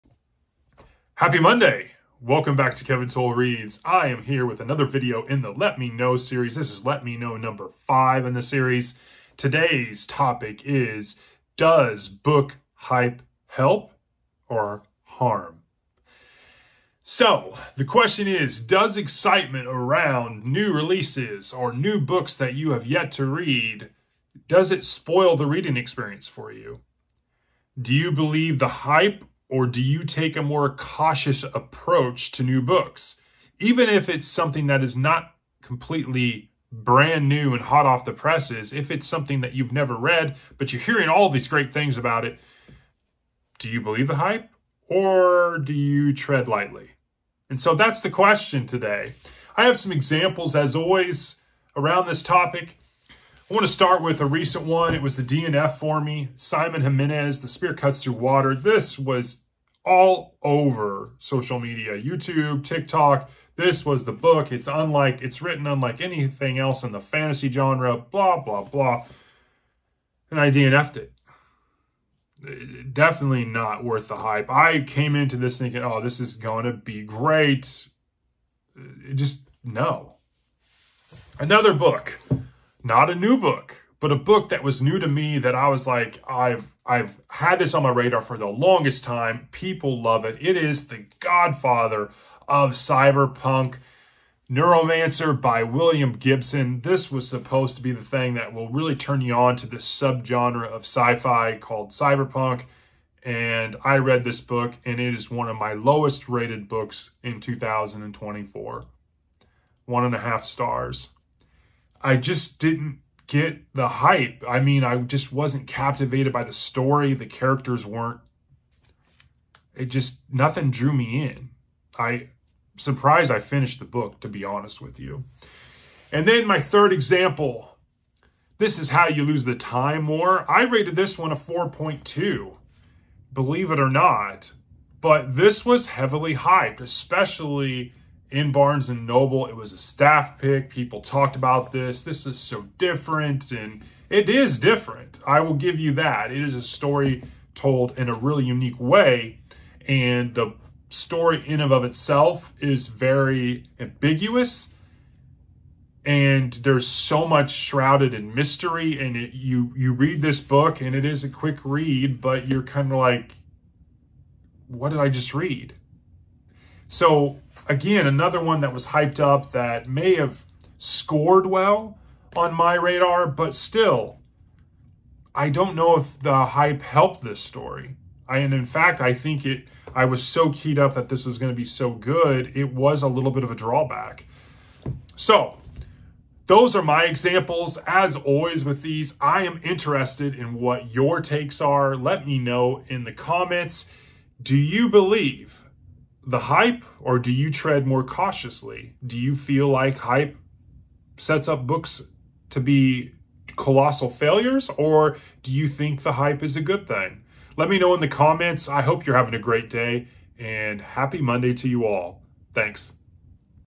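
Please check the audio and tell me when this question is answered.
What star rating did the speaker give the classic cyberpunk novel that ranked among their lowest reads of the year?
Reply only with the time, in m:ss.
1:49.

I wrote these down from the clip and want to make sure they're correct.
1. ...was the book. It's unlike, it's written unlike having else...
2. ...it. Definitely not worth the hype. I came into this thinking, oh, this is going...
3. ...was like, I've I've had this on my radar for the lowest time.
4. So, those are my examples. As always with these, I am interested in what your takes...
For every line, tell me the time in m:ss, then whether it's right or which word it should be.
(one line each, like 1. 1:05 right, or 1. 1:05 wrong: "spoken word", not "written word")
1. 1:03 wrong: "anything", not "having"
2. 1:10 right
3. 1:25 wrong: "longest", not "lowest"
4. 3:05 right.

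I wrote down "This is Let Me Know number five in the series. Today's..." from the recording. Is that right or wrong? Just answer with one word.
right.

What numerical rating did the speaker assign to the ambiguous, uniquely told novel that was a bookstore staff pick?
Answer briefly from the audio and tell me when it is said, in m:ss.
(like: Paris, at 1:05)
4.2, at 2:11.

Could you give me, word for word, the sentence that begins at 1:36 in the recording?
This was supposed to be the thing that will really turn you on to this subgenre of sci-fi called cyberpunk.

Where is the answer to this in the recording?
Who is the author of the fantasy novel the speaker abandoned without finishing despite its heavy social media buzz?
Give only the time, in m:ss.
0:56.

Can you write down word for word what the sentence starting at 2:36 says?
And there's so much shrouded in mystery.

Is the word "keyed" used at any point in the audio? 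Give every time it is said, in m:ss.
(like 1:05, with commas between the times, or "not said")
3:00.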